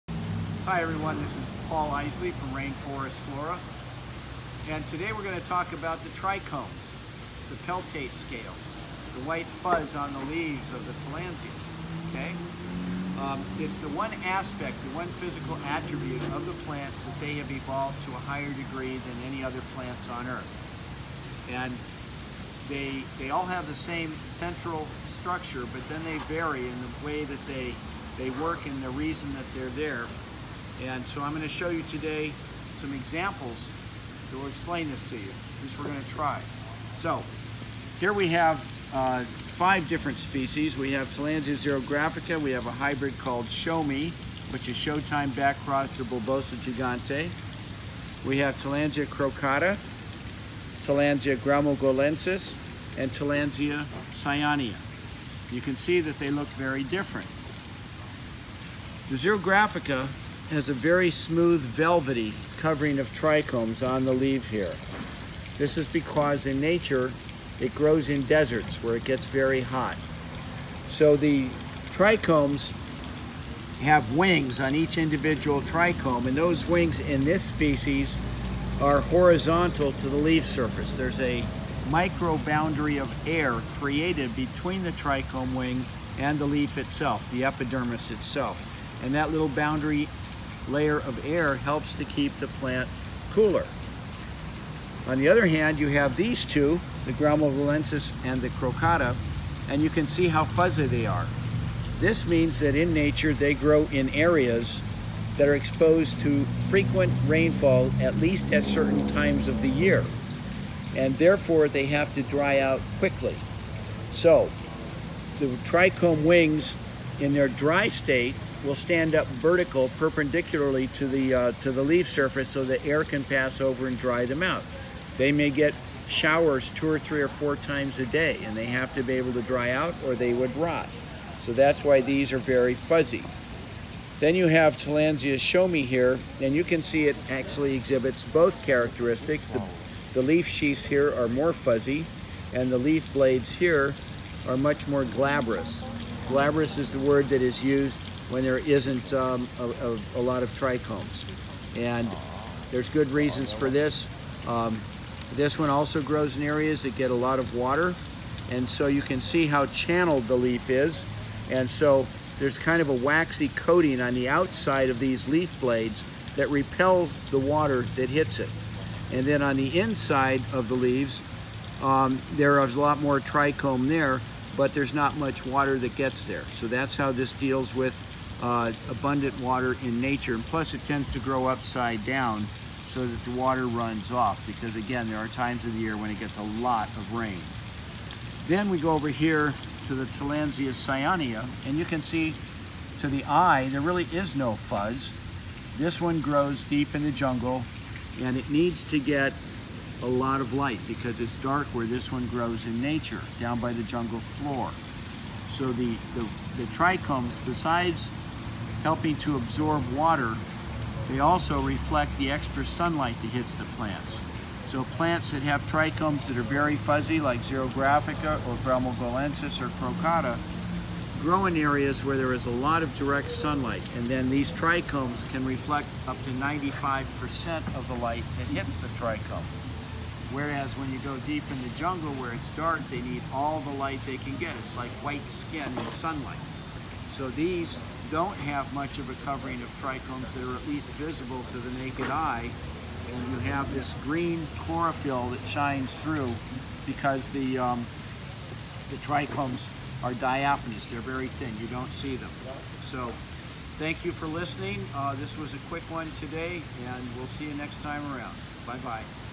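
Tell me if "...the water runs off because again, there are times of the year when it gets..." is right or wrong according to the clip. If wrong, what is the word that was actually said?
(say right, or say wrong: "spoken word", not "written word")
right.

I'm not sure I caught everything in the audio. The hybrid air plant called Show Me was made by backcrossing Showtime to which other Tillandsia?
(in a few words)
Bulbosa gigante.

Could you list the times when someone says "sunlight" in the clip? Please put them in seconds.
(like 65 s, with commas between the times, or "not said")
212 s, 223 s, 235 s.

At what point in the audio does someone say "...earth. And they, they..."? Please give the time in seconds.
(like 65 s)
20 s.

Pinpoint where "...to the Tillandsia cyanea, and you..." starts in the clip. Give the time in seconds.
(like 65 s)
189 s.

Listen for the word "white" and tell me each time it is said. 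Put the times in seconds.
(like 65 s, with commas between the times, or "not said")
9 s, 235 s.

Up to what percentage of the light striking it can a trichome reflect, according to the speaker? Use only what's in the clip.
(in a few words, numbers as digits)
95%.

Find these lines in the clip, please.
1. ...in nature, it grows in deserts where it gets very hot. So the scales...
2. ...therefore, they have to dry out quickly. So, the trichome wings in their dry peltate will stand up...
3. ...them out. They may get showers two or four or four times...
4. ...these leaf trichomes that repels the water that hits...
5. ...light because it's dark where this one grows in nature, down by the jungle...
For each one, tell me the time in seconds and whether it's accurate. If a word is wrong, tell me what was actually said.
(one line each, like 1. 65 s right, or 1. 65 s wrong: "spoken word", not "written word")
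1. 66 s wrong: "trichomes", not "scales"
2. 111 s wrong: "state", not "peltate"
3. 124 s wrong: "three", not "four"
4. 164 s wrong: "blades", not "trichomes"
5. 200 s right.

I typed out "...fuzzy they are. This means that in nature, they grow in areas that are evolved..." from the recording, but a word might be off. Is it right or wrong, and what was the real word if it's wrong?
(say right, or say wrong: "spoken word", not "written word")
wrong: "exposed", not "evolved".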